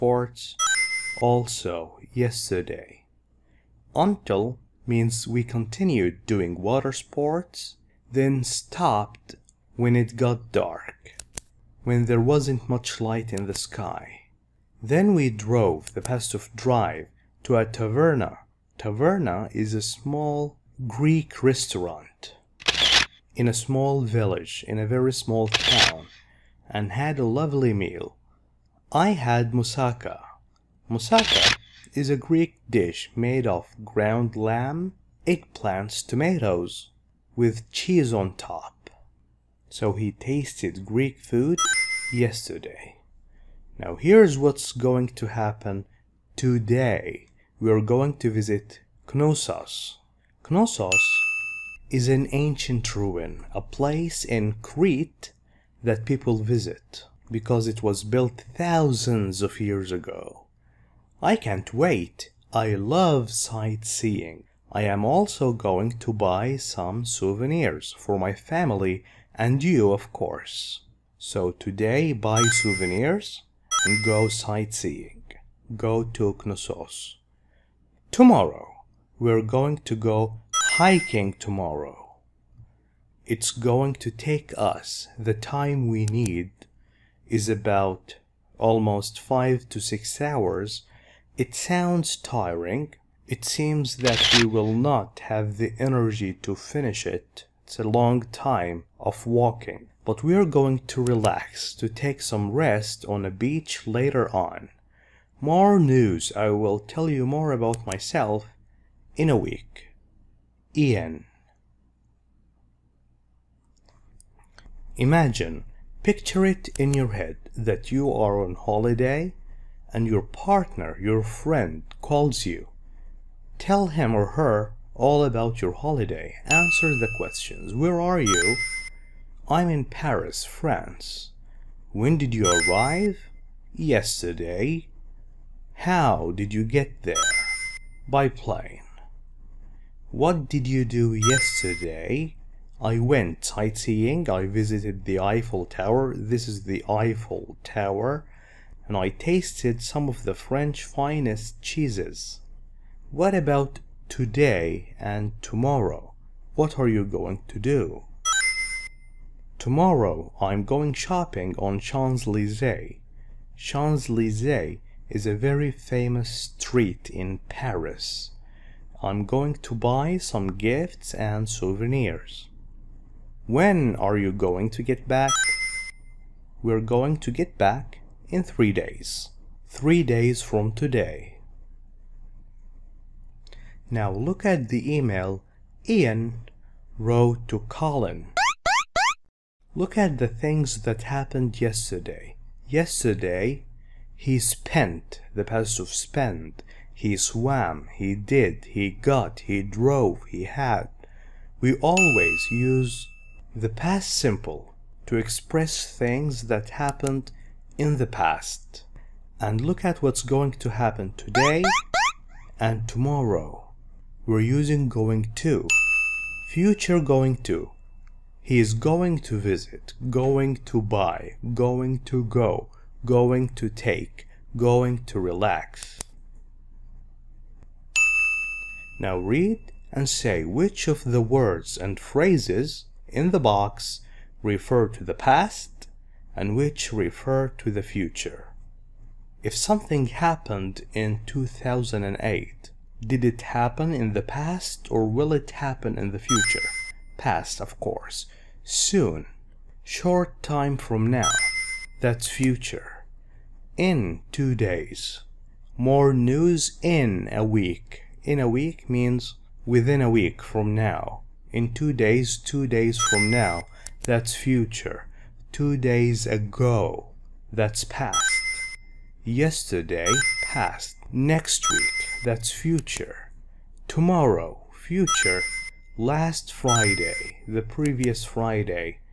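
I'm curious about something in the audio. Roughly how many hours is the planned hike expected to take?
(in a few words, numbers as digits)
5 to 6 hours.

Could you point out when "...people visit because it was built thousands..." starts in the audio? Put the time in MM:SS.
00:56.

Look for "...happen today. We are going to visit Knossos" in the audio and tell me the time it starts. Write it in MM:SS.
00:45.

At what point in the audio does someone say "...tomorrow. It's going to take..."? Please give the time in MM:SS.
01:21.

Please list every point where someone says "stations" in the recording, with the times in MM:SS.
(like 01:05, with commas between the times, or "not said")
not said.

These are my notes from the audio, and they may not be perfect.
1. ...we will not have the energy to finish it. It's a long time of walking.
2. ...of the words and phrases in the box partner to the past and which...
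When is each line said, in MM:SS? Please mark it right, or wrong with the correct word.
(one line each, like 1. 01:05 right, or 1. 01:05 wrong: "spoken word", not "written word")
1. 01:34 right
2. 03:50 wrong: "refer", not "partner".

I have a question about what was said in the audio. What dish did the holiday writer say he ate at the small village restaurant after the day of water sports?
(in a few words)
Moussaka.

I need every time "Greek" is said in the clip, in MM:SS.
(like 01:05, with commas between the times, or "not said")
00:20, 00:32, 00:40.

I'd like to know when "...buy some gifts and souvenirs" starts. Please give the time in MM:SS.
02:49.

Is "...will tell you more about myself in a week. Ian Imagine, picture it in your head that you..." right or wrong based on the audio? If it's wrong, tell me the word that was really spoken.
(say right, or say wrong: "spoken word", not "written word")
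right.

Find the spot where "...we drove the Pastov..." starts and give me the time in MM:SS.
00:15.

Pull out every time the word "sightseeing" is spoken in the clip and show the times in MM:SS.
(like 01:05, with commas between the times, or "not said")
01:03, 01:14, 02:23.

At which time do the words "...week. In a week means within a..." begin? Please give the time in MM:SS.
04:17.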